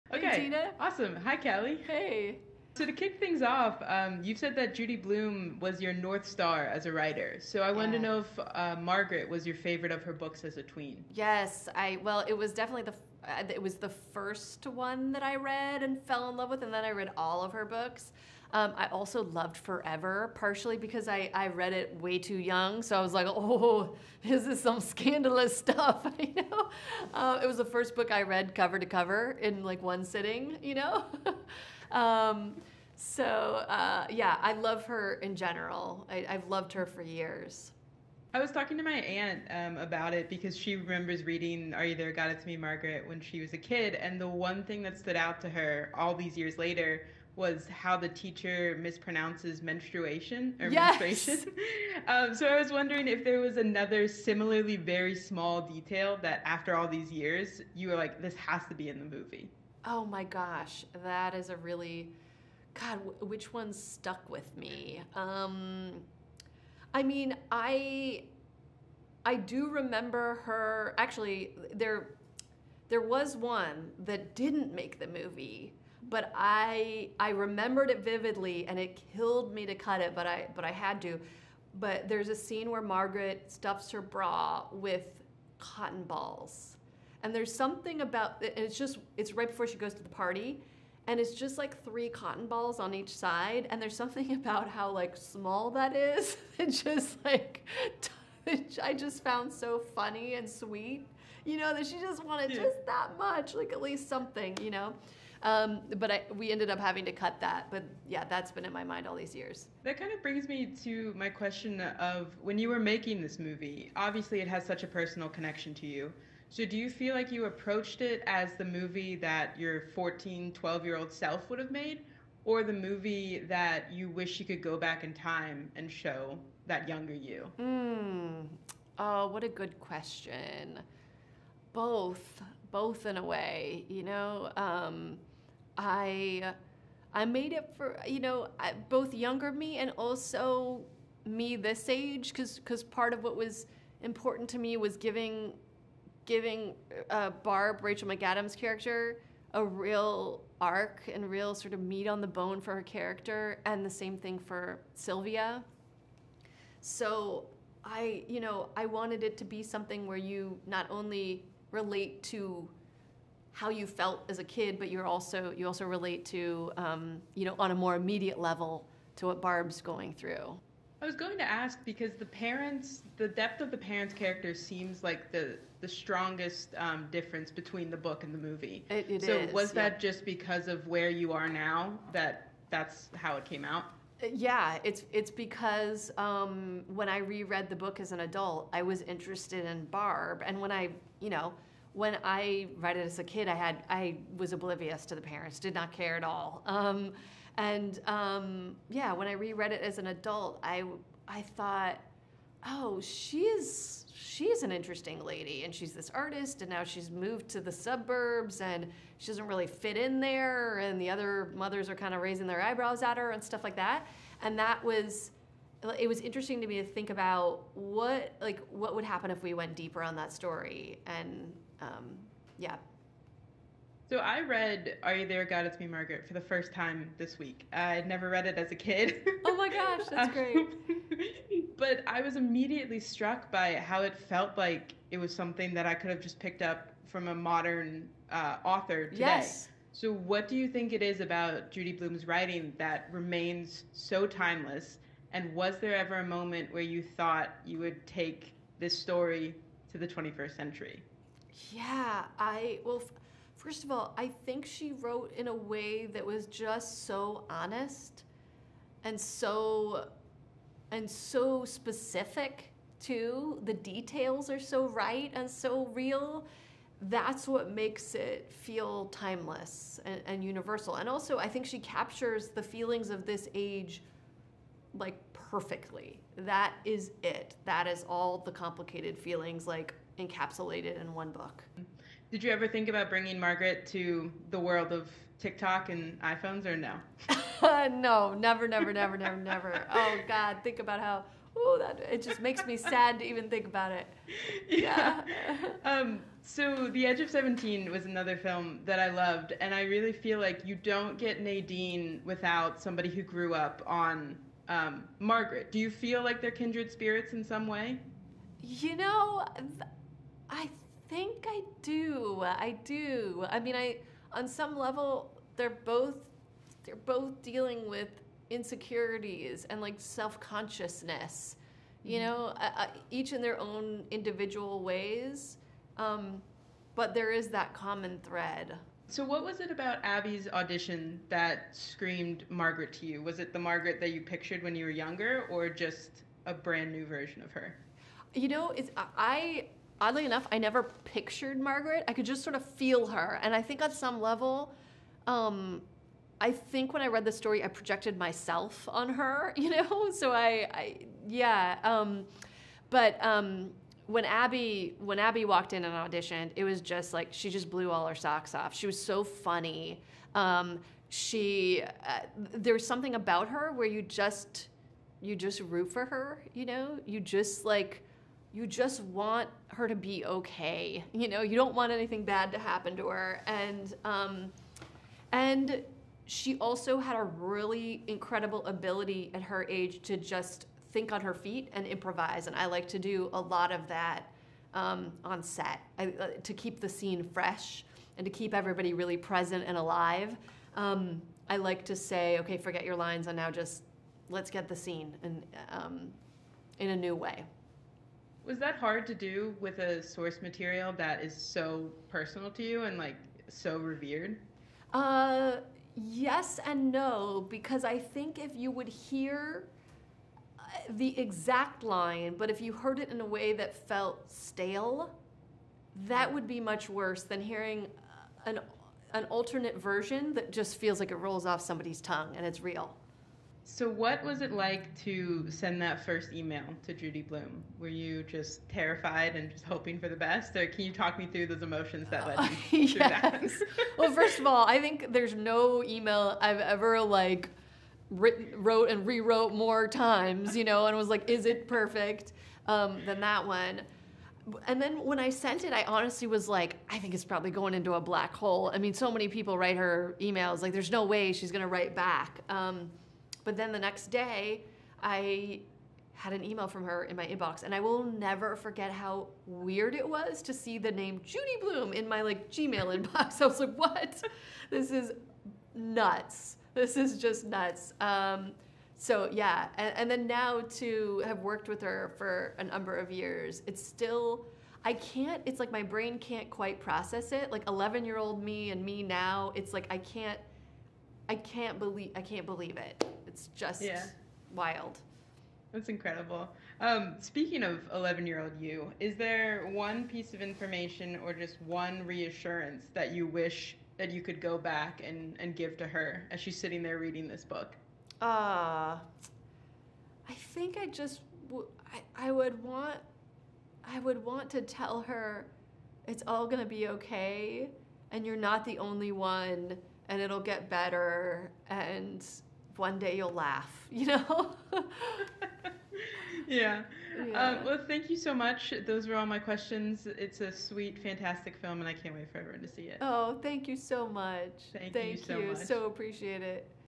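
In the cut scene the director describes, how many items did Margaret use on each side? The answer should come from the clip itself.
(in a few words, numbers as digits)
3.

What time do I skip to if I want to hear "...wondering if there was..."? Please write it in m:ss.
0:52.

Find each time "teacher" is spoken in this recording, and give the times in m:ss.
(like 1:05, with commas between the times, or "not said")
0:48.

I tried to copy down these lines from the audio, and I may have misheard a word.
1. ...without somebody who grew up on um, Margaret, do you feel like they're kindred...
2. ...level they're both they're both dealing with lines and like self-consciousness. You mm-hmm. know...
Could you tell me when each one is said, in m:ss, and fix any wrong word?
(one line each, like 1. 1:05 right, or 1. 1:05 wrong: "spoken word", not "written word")
1. 5:02 right
2. 5:14 wrong: "insecurities", not "lines".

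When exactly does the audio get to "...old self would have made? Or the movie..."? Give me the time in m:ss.
2:00.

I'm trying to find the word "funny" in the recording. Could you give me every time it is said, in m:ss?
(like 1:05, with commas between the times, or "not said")
1:39, 5:59.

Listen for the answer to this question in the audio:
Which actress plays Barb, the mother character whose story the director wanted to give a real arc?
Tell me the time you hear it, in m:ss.
2:27.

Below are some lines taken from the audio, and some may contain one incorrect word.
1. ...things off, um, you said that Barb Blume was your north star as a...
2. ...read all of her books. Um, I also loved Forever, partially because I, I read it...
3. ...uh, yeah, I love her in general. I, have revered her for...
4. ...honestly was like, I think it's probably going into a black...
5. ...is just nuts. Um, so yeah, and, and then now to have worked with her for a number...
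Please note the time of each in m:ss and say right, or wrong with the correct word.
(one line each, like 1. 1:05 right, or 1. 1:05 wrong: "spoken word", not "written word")
1. 0:03 wrong: "Judy", not "Barb"
2. 0:16 right
3. 0:33 wrong: "loved", not "revered"
4. 7:25 right
5. 7:46 right.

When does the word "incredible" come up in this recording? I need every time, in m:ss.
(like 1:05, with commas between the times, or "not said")
6:18, 8:05.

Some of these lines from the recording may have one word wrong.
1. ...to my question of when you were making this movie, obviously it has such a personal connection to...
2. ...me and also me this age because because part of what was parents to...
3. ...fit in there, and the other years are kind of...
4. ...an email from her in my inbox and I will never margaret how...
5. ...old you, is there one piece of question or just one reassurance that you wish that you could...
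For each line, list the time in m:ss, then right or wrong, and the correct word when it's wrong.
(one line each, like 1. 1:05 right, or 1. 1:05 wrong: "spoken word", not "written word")
1. 1:50 right
2. 2:19 wrong: "important", not "parents"
3. 3:29 wrong: "mothers", not "years"
4. 7:36 wrong: "forget", not "margaret"
5. 8:08 wrong: "information", not "question".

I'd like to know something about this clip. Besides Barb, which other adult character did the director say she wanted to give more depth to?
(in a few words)
Sylvia.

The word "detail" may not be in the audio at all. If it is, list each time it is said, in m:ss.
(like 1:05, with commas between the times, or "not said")
0:55, 4:23.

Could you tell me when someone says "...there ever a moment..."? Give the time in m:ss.
4:05.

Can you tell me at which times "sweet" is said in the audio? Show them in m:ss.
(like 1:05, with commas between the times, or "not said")
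1:40, 8:40.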